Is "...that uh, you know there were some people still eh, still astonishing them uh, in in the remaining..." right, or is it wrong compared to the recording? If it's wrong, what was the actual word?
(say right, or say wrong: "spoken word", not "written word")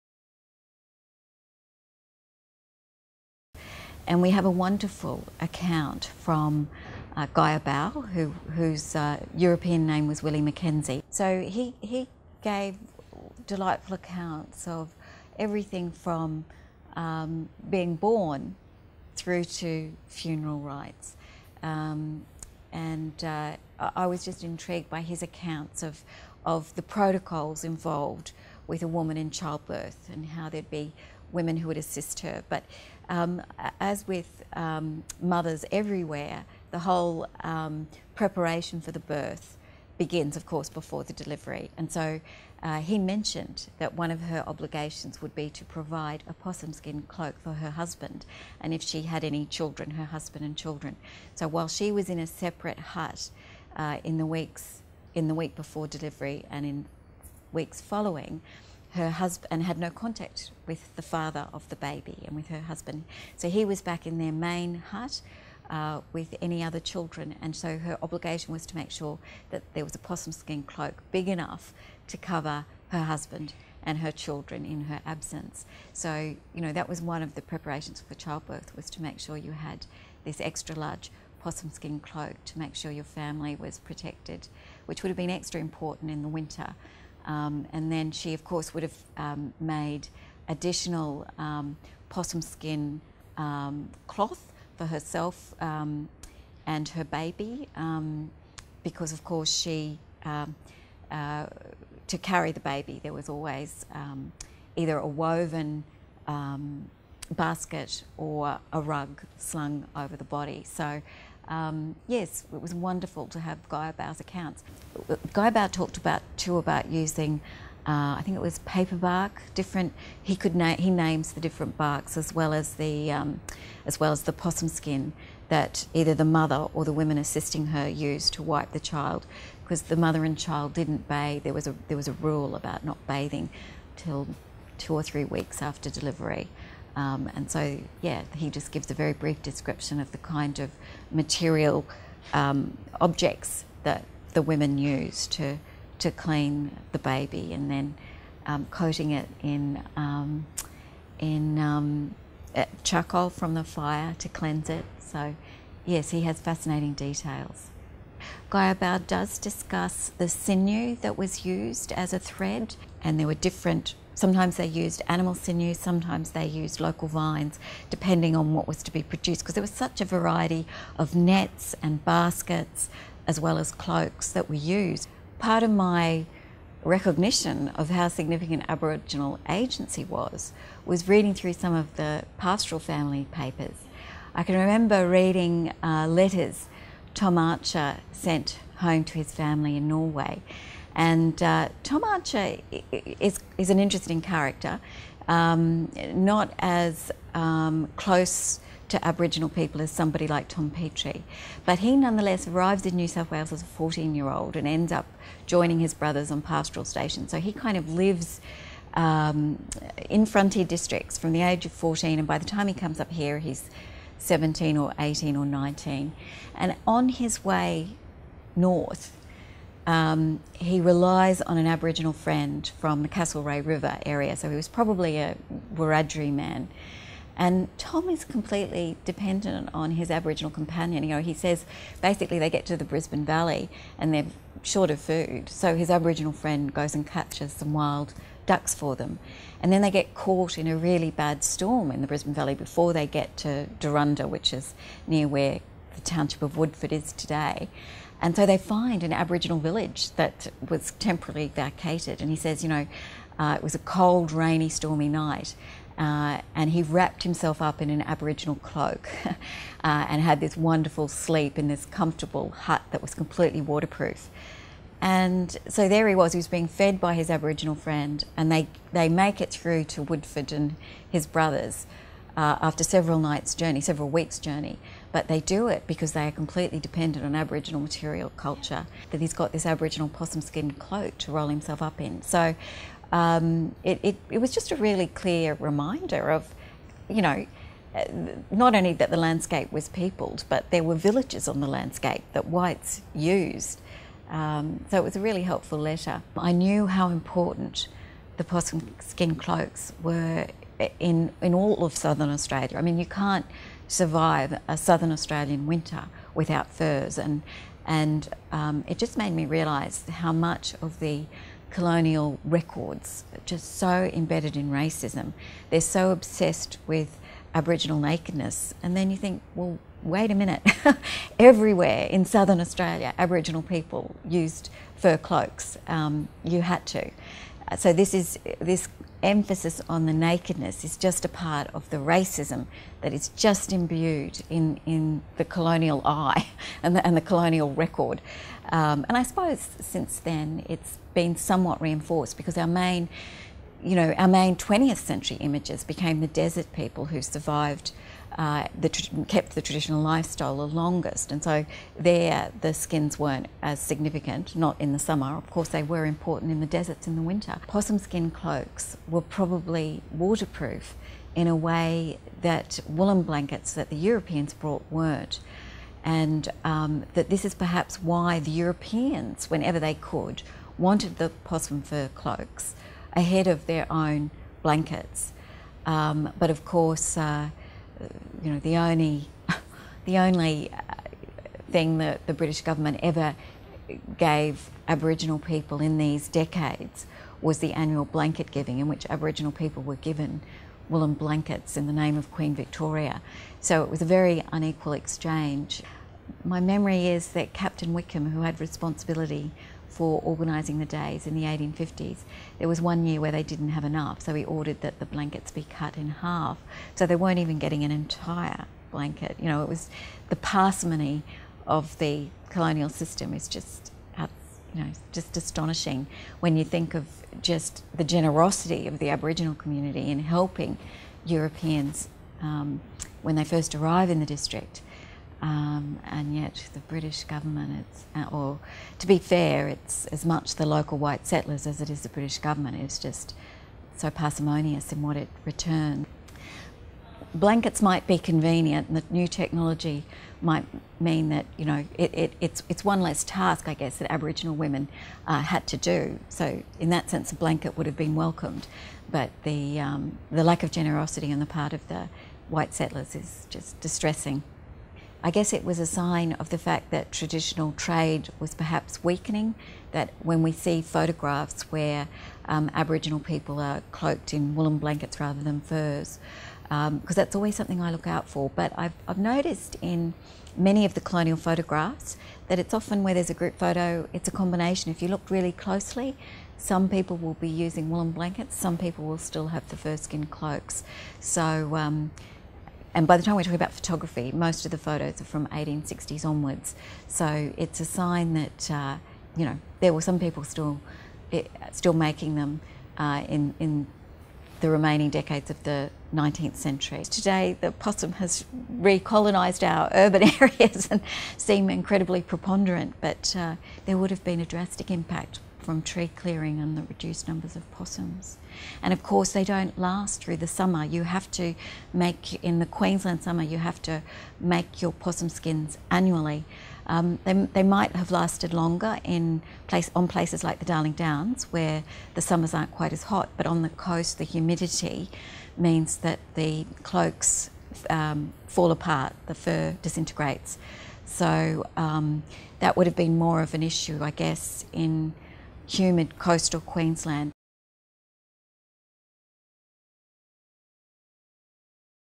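wrong: "making", not "astonishing".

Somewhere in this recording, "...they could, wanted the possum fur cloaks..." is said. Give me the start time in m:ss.
6:09.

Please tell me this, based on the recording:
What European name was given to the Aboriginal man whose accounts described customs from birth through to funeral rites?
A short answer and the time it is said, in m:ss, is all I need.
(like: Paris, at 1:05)
Willie McKenzie, at 0:10.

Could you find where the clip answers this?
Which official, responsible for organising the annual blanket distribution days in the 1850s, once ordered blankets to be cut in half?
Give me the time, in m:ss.
6:37.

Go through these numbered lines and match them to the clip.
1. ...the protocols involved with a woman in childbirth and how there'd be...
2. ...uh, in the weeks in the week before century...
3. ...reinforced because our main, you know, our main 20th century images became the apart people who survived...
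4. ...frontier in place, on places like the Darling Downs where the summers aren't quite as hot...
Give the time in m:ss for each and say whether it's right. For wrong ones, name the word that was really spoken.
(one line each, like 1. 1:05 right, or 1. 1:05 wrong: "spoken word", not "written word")
1. 0:26 right
2. 0:53 wrong: "delivery", not "century"
3. 5:41 wrong: "desert", not "apart"
4. 8:38 wrong: "longer", not "frontier".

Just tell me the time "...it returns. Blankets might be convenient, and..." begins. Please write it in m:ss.
7:15.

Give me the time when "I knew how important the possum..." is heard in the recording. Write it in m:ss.
4:56.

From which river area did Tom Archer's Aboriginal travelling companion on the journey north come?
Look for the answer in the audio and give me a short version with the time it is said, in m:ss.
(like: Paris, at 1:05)
Castlereagh River, at 3:43.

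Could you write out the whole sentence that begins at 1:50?
So um, yes, it was wonderful to have Gaiarbau's accounts.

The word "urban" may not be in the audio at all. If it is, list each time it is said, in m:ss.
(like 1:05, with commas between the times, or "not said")
8:19.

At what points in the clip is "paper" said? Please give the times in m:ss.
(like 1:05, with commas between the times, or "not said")
1:58, 3:03.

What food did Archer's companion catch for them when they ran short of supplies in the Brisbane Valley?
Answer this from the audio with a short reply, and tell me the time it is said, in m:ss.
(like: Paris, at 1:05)
wild ducks, at 3:57.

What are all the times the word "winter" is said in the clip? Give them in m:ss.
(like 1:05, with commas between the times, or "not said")
1:26, 5:05, 5:57.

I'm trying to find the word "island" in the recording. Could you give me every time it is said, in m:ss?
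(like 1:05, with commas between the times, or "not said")
not said.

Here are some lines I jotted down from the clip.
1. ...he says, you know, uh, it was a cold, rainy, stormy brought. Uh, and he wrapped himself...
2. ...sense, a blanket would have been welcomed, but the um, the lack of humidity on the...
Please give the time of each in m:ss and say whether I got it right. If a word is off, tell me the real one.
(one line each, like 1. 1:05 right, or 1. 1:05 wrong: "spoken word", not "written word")
1. 4:12 wrong: "night", not "brought"
2. 7:27 wrong: "generosity", not "humidity".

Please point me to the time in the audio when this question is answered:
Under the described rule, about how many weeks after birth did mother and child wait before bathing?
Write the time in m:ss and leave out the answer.
2:14.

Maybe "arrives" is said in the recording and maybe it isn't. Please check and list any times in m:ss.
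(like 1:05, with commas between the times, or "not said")
3:22, 7:03.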